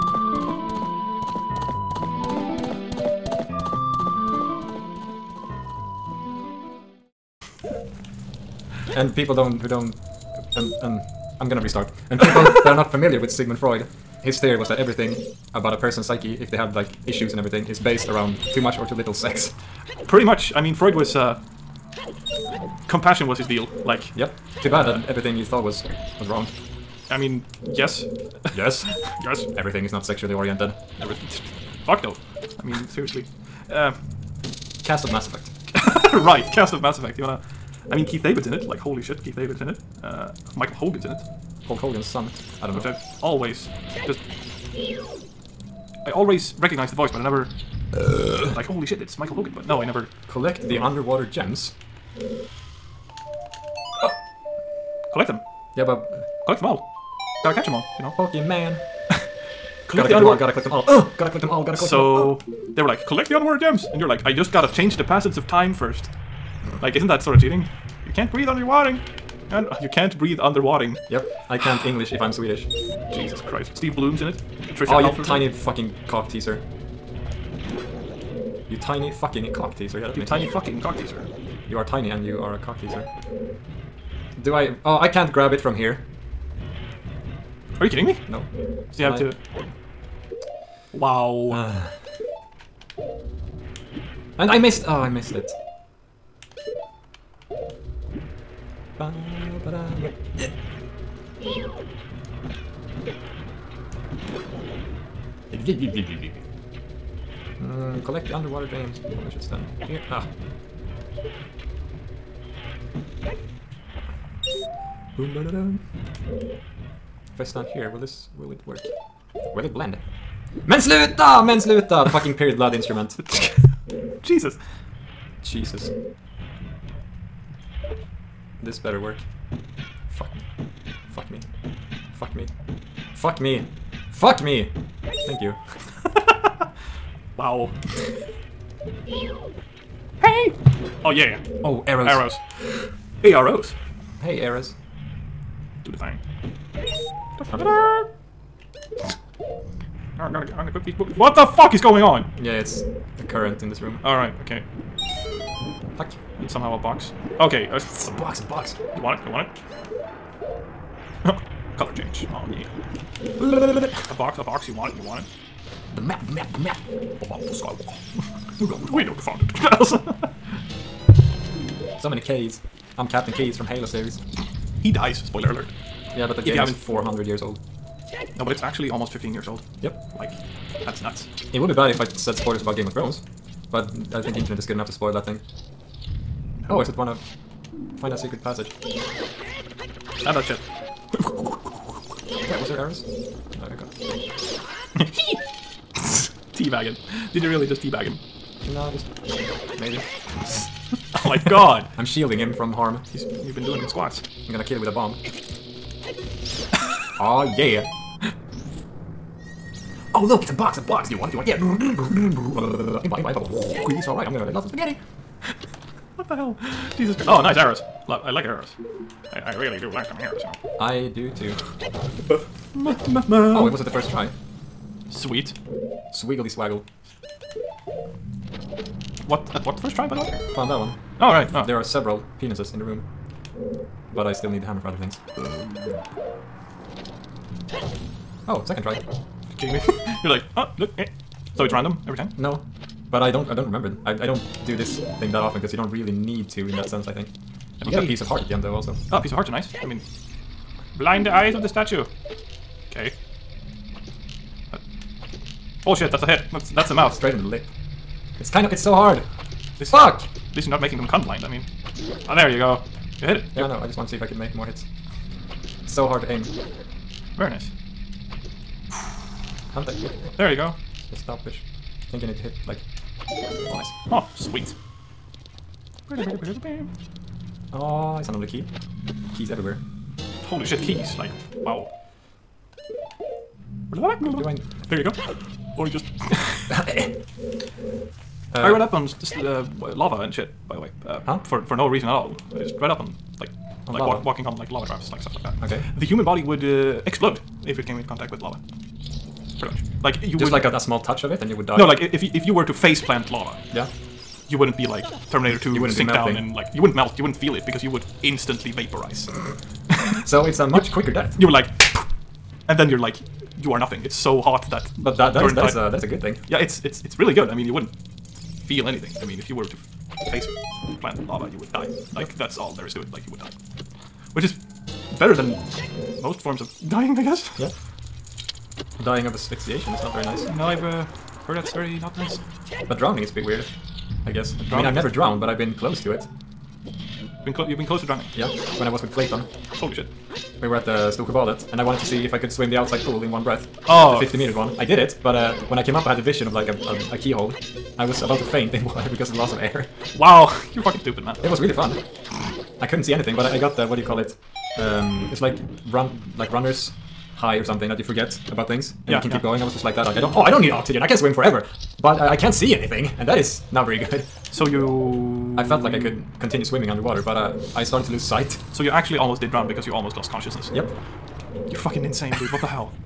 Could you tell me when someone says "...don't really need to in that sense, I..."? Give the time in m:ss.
4:05.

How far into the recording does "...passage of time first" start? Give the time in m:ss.
1:05.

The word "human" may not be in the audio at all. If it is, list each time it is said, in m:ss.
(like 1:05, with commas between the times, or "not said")
4:56.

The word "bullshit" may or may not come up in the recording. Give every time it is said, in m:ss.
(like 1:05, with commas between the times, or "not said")
4:15.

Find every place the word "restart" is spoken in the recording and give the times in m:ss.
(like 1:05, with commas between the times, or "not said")
0:11.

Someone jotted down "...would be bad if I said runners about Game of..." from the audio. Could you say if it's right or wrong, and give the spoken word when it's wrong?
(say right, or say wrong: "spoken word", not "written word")
wrong: "spoilers", not "runners".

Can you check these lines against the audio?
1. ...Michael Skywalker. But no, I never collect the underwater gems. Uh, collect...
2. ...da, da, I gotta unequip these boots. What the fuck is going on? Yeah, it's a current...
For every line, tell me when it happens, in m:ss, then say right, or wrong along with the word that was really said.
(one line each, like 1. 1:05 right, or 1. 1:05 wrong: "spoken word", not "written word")
1. 0:49 wrong: "Hogan", not "Skywalker"
2. 2:27 right.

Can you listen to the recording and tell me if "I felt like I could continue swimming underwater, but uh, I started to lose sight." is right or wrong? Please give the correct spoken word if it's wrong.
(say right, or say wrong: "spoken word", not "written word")
right.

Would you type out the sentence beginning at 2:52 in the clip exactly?
I'm Captain Keyes from Halo series.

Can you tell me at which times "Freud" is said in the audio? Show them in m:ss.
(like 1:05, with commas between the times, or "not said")
0:13, 0:20.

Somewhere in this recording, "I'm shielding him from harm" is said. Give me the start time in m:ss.
3:21.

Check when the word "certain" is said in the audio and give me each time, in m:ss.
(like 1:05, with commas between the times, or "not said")
not said.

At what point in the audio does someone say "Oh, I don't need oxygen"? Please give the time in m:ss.
6:00.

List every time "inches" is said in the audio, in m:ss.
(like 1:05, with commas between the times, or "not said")
not said.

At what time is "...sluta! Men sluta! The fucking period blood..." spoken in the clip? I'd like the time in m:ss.
2:00.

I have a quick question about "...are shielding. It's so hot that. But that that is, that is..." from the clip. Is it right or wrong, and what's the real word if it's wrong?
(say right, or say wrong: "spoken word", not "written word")
wrong: "nothing", not "shielding".